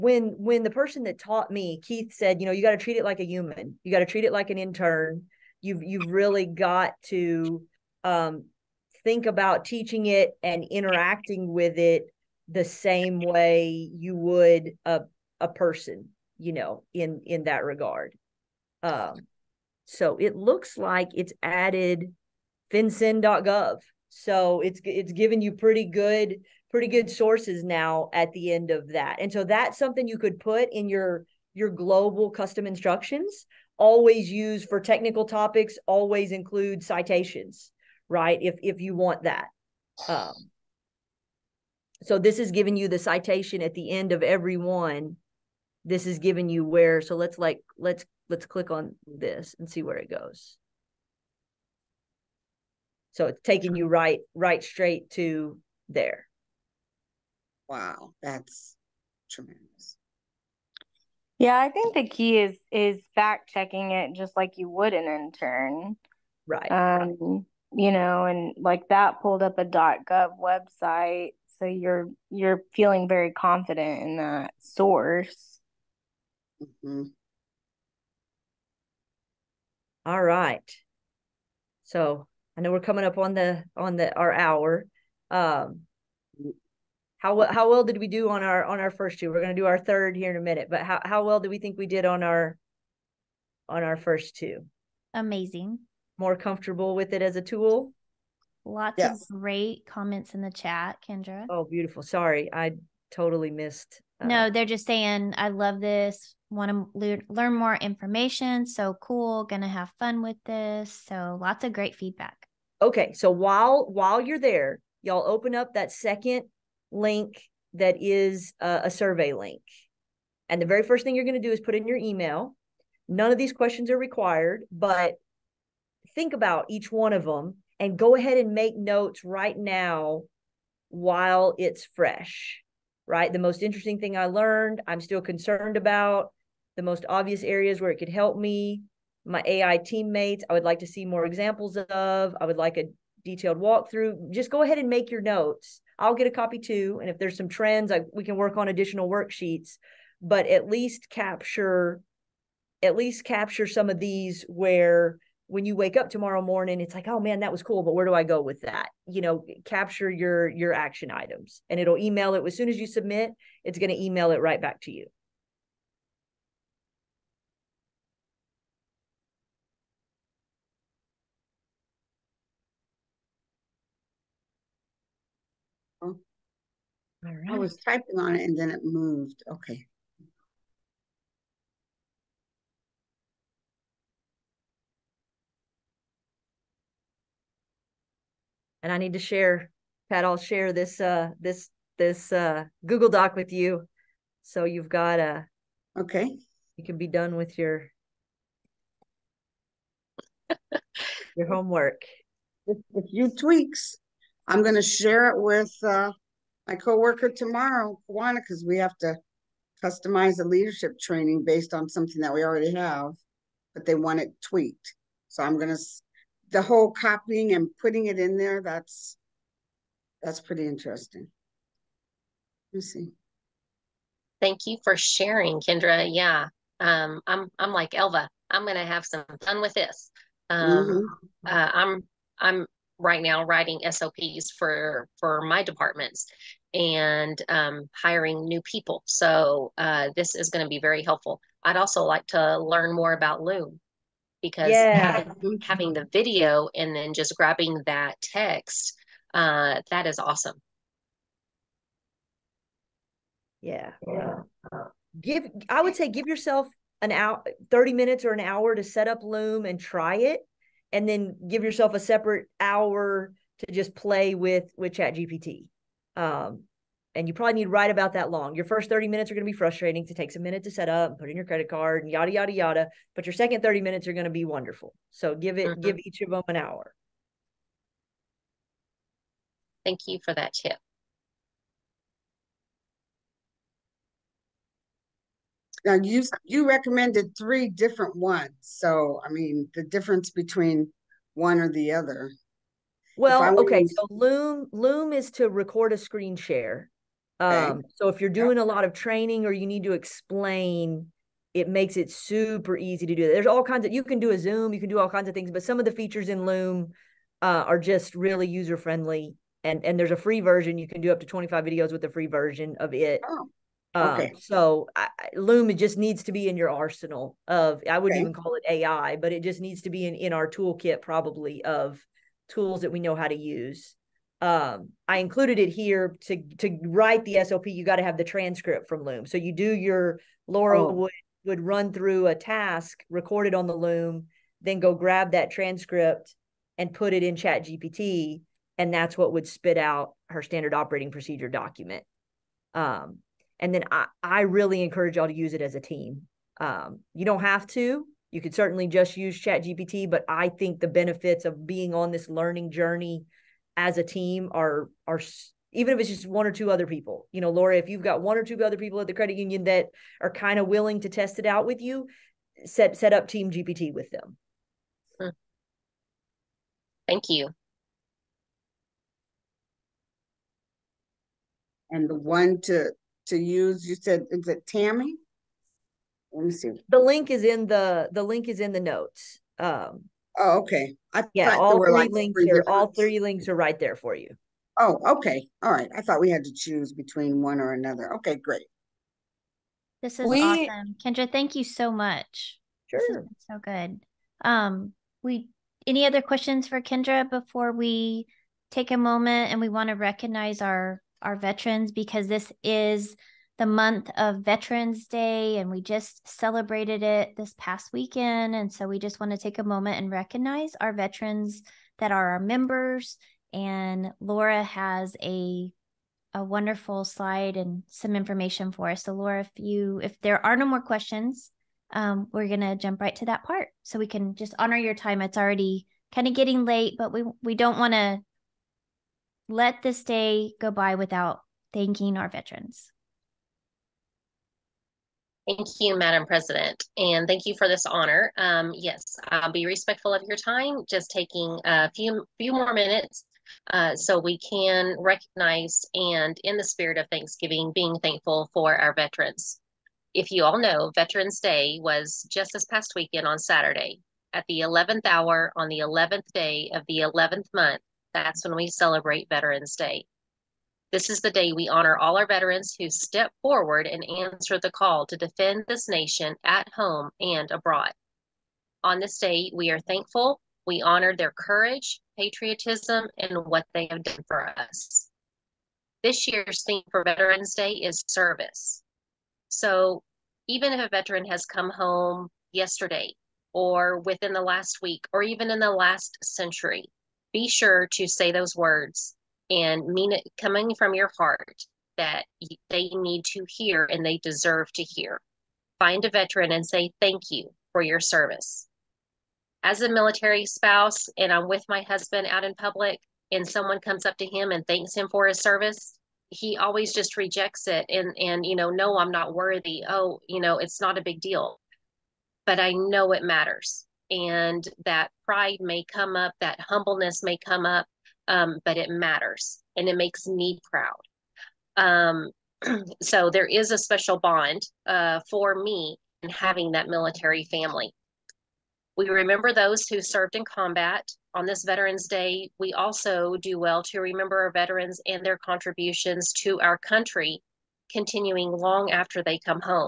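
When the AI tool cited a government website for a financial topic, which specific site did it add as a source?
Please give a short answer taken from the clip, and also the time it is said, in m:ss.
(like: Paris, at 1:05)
fincen.gov, at 0:22.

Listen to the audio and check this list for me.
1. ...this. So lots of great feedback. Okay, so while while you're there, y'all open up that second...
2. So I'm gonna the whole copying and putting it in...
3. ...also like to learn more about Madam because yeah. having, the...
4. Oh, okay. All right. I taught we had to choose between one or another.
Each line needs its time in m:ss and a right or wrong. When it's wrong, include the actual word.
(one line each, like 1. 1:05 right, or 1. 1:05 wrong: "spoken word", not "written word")
1. 1:50 right
2. 3:35 right
3. 4:01 wrong: "Loom", not "Madam"
4. 6:24 wrong: "thought", not "taught".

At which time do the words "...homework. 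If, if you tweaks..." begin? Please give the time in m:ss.
3:21.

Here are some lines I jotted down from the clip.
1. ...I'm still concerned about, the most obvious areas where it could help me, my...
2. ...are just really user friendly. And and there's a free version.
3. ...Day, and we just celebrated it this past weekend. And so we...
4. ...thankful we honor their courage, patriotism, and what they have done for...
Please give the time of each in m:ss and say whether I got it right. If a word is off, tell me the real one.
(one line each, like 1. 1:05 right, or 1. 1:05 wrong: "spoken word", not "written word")
1. 2:14 right
2. 5:07 right
3. 6:45 right
4. 7:49 right.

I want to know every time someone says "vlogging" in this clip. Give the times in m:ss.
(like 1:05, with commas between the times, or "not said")
not said.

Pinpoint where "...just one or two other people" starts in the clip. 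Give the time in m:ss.
5:56.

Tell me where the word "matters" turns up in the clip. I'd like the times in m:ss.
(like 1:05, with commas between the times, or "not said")
8:33, 8:38.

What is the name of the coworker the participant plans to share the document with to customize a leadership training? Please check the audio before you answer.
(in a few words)
Kawana.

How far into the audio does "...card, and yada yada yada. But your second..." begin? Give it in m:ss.
4:31.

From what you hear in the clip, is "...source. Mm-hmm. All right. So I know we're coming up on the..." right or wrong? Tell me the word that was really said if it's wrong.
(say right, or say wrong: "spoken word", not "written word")
right.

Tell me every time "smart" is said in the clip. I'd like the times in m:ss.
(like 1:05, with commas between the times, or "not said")
not said.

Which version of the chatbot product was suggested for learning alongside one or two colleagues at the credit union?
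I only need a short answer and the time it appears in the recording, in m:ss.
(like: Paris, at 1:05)
Team GPT, at 6:03.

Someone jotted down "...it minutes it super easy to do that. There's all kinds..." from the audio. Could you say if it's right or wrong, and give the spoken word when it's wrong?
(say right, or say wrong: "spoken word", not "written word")
wrong: "makes", not "minutes".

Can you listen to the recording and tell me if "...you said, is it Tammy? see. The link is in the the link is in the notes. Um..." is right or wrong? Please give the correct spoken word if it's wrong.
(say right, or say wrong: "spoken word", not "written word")
right.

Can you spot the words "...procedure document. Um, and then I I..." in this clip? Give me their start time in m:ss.
5:41.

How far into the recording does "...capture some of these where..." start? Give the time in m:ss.
2:33.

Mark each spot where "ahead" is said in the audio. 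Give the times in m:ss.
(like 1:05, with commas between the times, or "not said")
2:08, 2:24.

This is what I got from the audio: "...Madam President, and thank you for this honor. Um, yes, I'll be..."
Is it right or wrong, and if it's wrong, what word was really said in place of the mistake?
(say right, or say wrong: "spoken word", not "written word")
right.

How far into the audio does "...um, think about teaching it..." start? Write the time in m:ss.
0:08.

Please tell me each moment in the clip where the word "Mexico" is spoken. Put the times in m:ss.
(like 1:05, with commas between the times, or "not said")
not said.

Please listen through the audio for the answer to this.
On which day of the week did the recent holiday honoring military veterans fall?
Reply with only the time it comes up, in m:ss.
7:33.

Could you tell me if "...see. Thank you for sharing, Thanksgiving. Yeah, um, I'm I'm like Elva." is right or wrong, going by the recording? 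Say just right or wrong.
wrong.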